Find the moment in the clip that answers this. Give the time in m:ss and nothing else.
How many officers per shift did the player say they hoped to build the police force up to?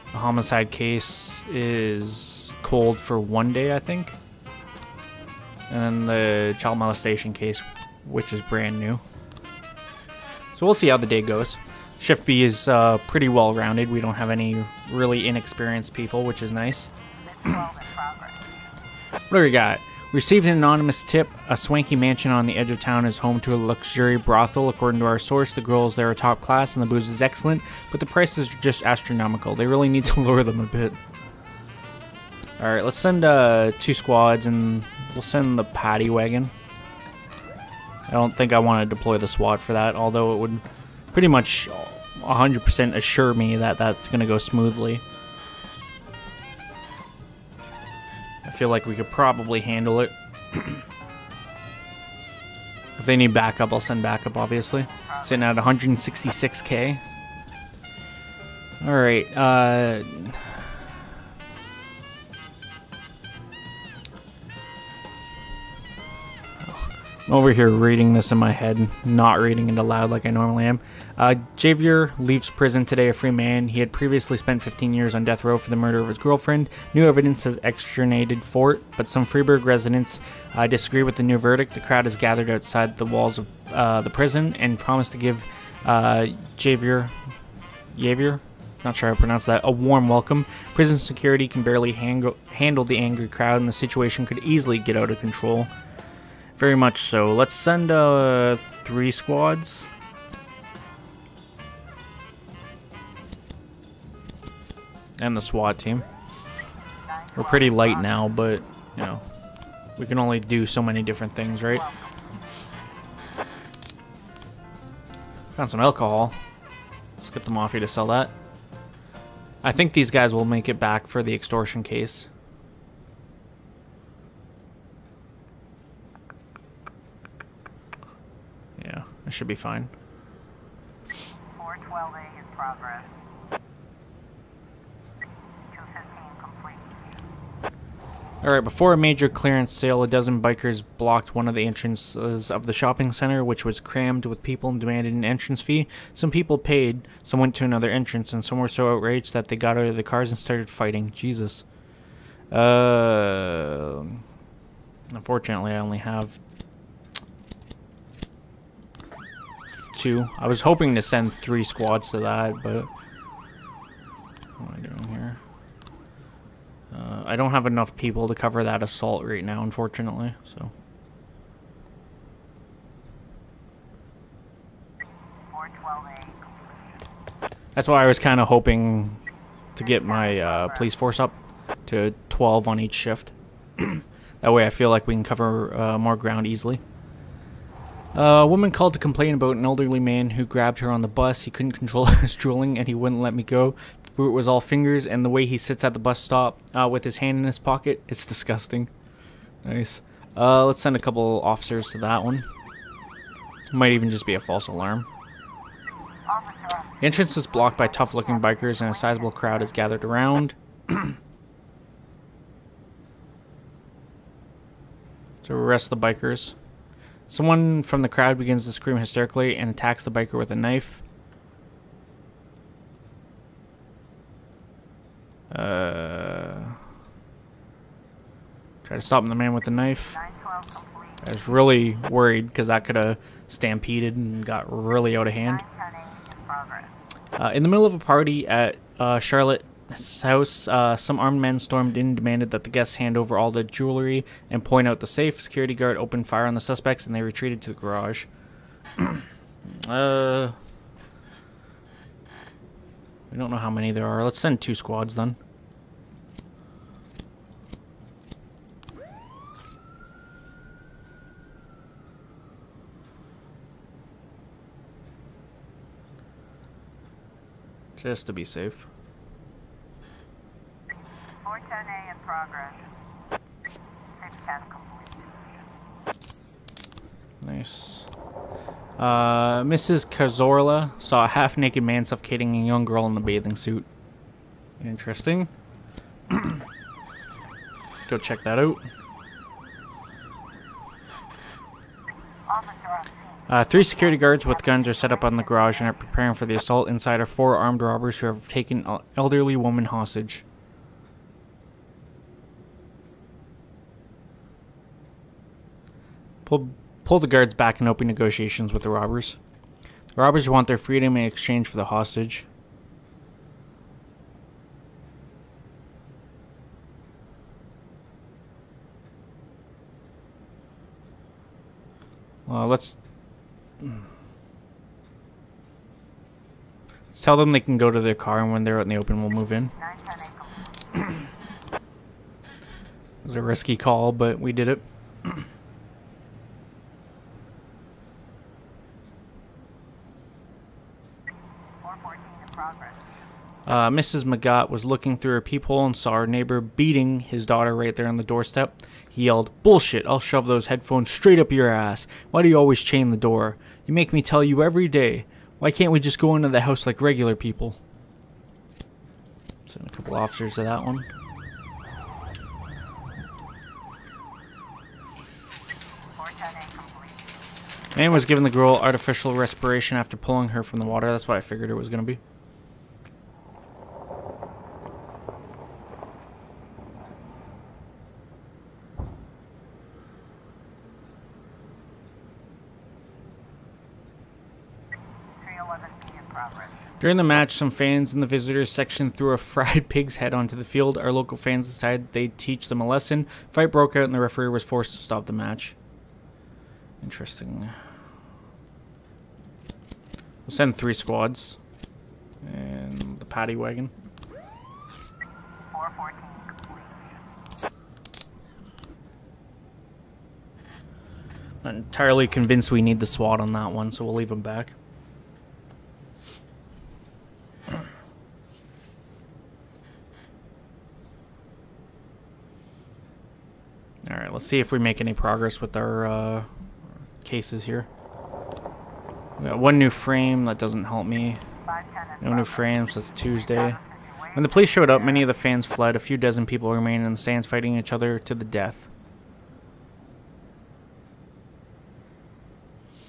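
3:02.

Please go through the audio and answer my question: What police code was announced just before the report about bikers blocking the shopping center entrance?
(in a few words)
412A.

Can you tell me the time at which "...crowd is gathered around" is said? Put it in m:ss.
3:29.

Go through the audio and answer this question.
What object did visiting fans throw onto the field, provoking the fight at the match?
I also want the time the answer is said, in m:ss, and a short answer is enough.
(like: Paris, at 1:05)
fried pig's head, at 6:29.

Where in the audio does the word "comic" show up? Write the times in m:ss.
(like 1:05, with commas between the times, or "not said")
not said.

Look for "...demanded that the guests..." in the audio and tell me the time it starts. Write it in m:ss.
4:02.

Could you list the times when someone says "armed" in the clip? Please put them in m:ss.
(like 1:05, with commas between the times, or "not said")
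4:01, 4:57.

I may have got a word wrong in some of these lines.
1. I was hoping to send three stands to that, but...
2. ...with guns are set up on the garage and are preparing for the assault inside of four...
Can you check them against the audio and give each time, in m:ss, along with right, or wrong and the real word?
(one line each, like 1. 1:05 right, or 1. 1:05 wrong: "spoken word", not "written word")
1. 2:40 wrong: "squads", not "stands"
2. 4:54 right.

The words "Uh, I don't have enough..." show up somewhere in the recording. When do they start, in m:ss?
2:46.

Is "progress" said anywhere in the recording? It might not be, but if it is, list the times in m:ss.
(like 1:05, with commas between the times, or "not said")
2:12, 4:32, 7:05.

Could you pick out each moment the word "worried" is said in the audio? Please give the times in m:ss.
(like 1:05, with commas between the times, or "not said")
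3:52.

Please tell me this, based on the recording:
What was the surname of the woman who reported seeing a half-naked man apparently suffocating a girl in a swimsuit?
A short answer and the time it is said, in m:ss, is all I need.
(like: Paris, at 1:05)
Kazorla, at 4:40.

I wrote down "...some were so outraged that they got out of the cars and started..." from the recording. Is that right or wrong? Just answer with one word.
right.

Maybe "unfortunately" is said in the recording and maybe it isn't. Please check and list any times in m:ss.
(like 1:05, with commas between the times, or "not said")
2:35, 2:49.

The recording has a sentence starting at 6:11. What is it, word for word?
That's what I figured it was going to be.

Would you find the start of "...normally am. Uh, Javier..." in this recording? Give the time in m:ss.
1:10.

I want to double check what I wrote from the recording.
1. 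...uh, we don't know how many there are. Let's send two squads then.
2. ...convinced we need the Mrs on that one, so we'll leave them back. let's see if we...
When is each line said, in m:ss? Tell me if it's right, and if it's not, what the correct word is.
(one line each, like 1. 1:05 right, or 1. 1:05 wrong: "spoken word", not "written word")
1. 4:08 right
2. 6:52 wrong: "SWAT", not "Mrs".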